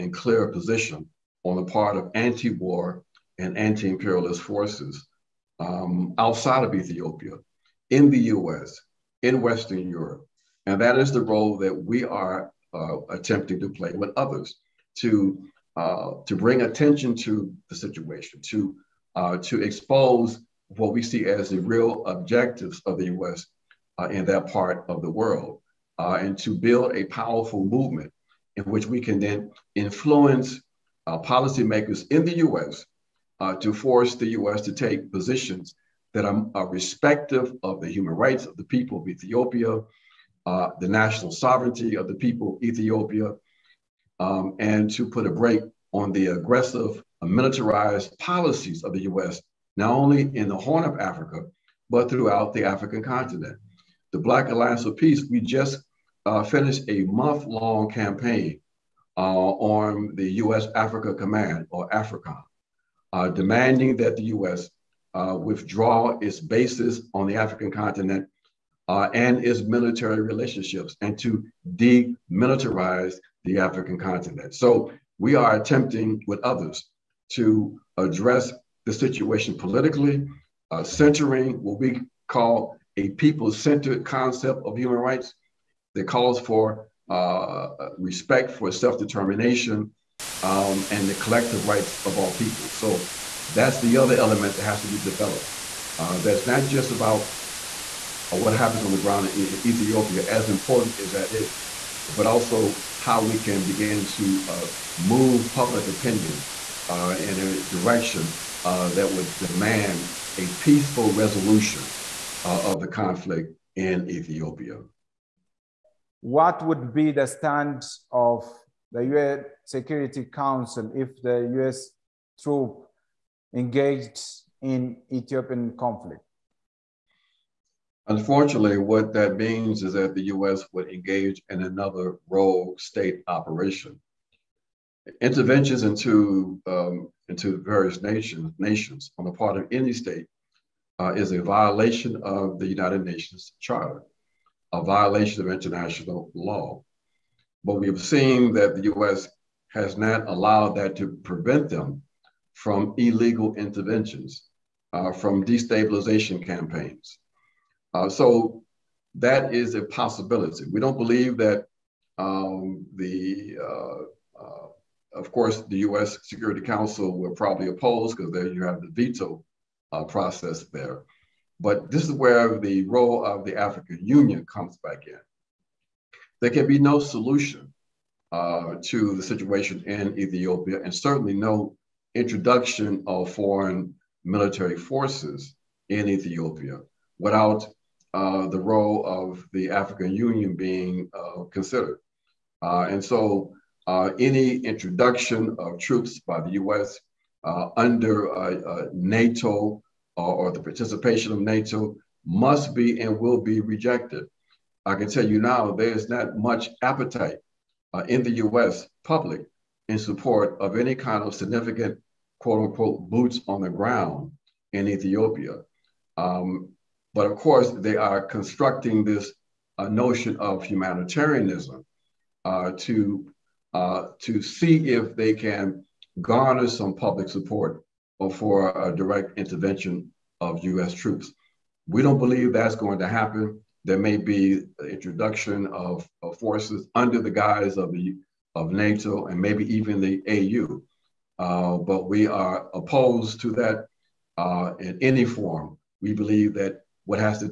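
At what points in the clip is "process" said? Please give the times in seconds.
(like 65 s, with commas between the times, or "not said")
170 s.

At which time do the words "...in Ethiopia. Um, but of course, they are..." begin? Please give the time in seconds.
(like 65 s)
214 s.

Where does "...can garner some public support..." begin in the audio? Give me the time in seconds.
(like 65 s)
225 s.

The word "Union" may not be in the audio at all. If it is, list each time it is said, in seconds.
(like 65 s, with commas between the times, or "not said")
174 s, 190 s.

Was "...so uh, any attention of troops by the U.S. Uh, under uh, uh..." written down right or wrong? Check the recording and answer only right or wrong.
wrong.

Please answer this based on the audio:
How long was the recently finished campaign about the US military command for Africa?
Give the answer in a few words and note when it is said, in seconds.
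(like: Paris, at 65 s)
a month, at 57 s.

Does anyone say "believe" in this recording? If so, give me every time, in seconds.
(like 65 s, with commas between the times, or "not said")
160 s, 232 s, 246 s.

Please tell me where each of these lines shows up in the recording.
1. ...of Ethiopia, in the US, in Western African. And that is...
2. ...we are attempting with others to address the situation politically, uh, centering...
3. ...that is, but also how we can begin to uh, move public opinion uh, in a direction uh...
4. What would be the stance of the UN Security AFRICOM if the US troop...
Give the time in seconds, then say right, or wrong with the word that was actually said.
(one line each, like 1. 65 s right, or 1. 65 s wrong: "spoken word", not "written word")
1. 6 s wrong: "Europe", not "African"
2. 75 s right
3. 101 s right
4. 116 s wrong: "Council", not "AFRICOM".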